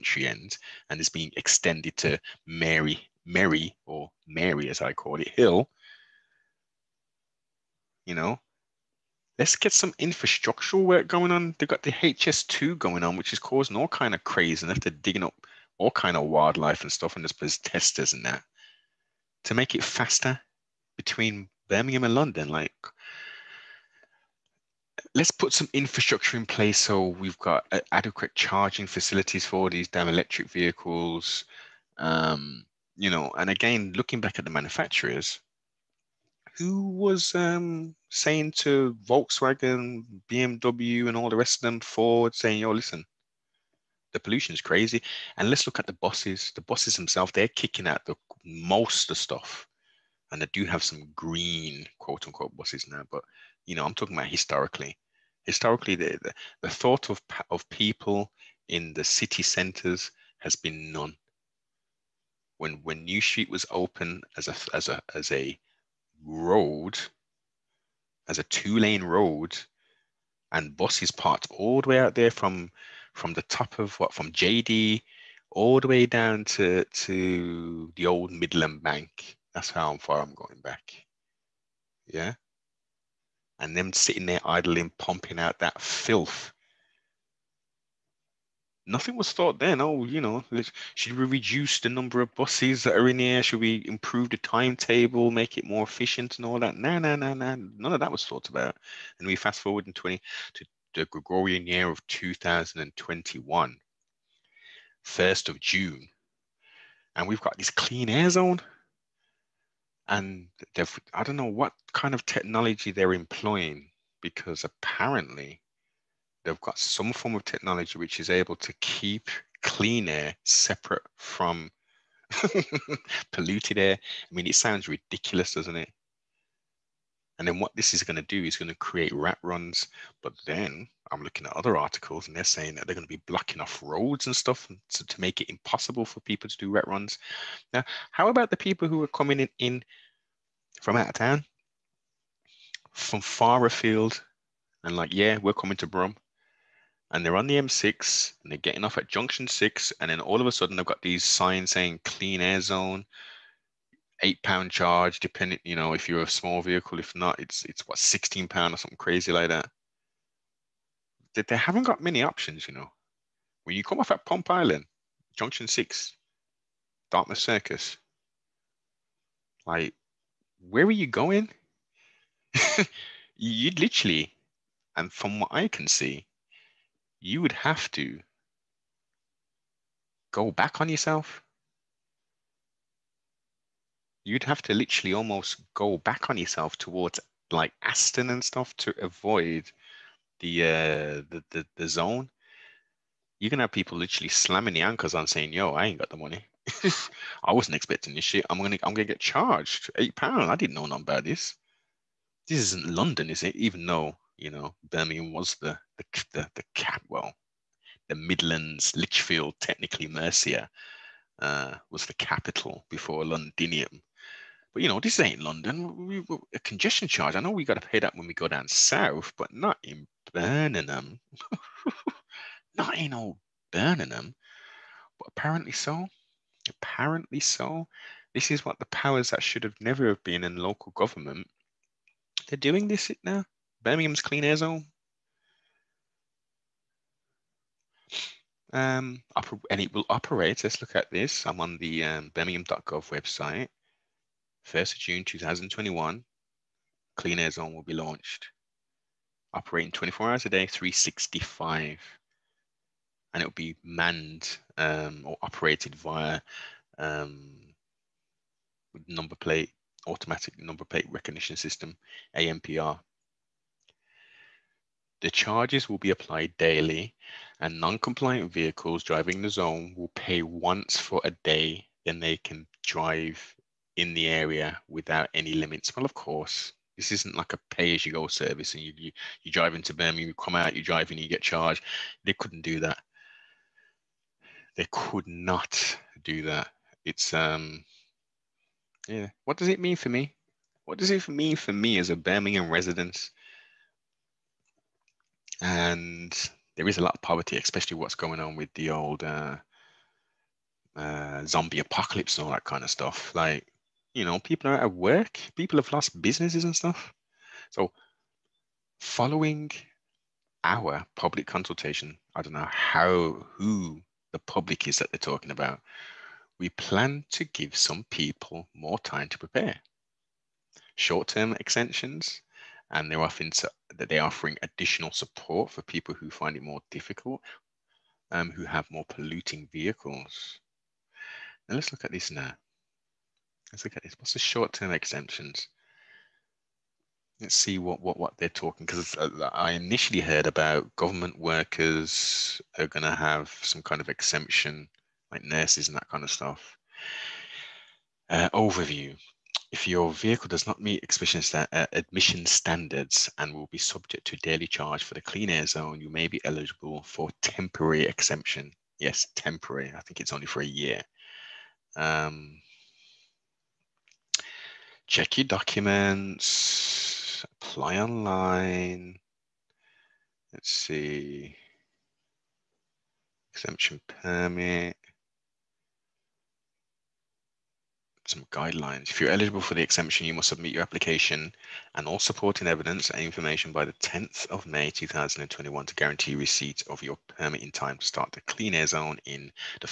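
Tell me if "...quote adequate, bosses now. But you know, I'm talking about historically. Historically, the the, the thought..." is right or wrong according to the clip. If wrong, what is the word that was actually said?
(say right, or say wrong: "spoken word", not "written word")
wrong: "unquote", not "adequate".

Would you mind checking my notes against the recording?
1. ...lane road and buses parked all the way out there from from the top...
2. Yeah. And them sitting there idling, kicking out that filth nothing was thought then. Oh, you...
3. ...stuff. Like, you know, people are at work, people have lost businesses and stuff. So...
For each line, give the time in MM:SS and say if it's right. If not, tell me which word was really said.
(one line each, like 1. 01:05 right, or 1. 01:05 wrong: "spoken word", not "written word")
1. 01:08 right
2. 01:22 wrong: "pumping", not "kicking"
3. 05:02 right.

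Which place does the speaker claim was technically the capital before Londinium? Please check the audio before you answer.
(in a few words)
Lichfield.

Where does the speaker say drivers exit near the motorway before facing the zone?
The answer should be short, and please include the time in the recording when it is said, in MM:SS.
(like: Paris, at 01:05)
Dartmouth Circus, at 02:47.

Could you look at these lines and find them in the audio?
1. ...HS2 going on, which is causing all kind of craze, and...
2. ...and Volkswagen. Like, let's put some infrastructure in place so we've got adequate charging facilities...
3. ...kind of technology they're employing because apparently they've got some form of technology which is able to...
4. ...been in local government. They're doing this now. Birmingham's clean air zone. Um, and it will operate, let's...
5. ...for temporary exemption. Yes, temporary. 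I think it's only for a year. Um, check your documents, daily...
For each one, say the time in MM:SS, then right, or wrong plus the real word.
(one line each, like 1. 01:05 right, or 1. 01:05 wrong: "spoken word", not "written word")
1. 00:11 right
2. 00:22 wrong: "London", not "Volkswagen"
3. 01:51 right
4. 03:50 right
5. 05:57 wrong: "apply", not "daily".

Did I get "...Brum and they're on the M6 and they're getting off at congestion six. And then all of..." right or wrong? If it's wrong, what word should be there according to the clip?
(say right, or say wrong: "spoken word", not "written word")
wrong: "junction", not "congestion".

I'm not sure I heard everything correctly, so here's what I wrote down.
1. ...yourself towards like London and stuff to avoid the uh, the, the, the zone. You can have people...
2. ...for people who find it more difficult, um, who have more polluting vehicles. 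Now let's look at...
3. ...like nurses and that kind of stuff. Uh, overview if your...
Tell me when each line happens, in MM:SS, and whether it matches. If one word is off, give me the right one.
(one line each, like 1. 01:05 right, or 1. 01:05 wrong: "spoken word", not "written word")
1. 03:06 wrong: "Aston", not "London"
2. 05:25 right
3. 05:45 right.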